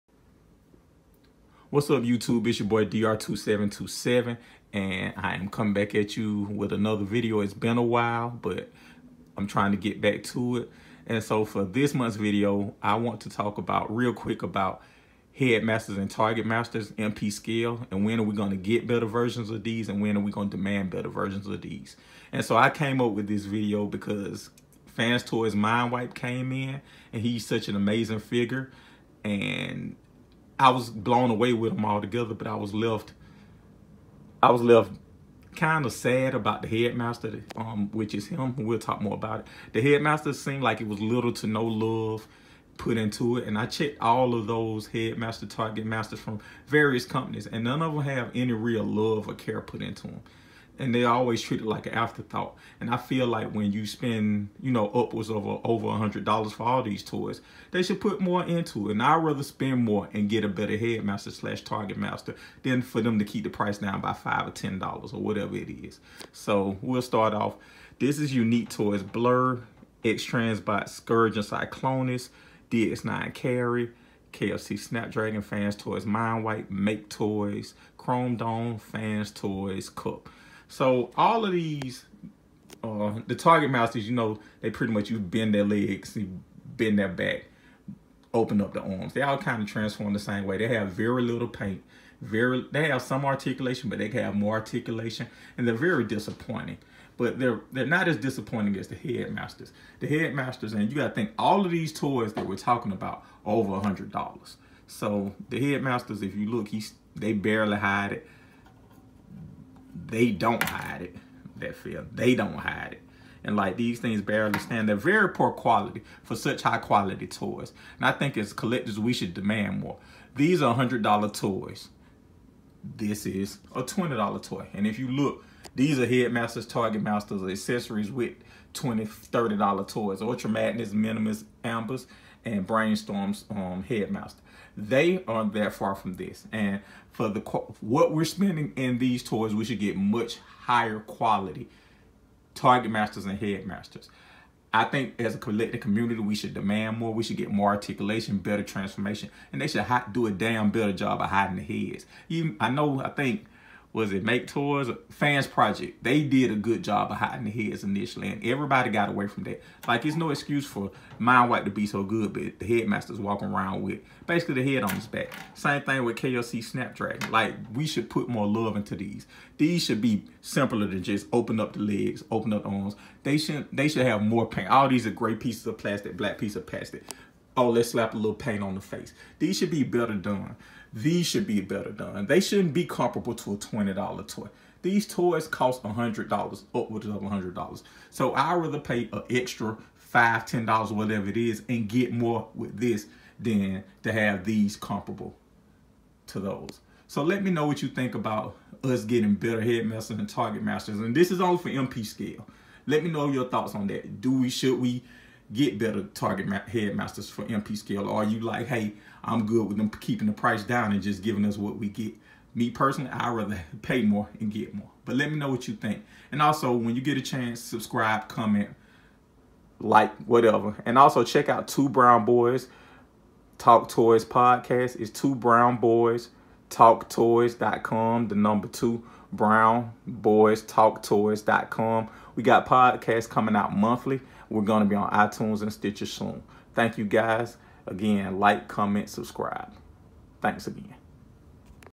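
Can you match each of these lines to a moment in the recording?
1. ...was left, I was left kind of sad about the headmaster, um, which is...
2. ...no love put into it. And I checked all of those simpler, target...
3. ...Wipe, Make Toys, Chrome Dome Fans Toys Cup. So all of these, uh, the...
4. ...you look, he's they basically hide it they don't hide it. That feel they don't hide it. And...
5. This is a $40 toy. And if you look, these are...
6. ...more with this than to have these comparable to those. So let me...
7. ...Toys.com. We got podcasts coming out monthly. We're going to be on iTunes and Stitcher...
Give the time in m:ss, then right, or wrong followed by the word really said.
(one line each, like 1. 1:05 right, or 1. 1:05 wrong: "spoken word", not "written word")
1. 0:32 right
2. 0:41 wrong: "headmaster", not "simpler"
3. 1:16 right
4. 1:46 wrong: "barely", not "basically"
5. 2:02 wrong: "20", not "40"
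6. 3:12 right
7. 3:51 right.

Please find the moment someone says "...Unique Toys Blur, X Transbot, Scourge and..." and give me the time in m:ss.
1:08.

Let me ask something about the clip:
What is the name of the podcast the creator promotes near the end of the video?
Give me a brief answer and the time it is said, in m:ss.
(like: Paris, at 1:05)
Two Brown Boys Talk Toys, at 3:41.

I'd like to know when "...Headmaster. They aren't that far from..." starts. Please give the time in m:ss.
2:13.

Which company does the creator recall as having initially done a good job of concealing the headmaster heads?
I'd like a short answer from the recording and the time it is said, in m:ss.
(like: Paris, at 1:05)
Fans Project, at 2:35.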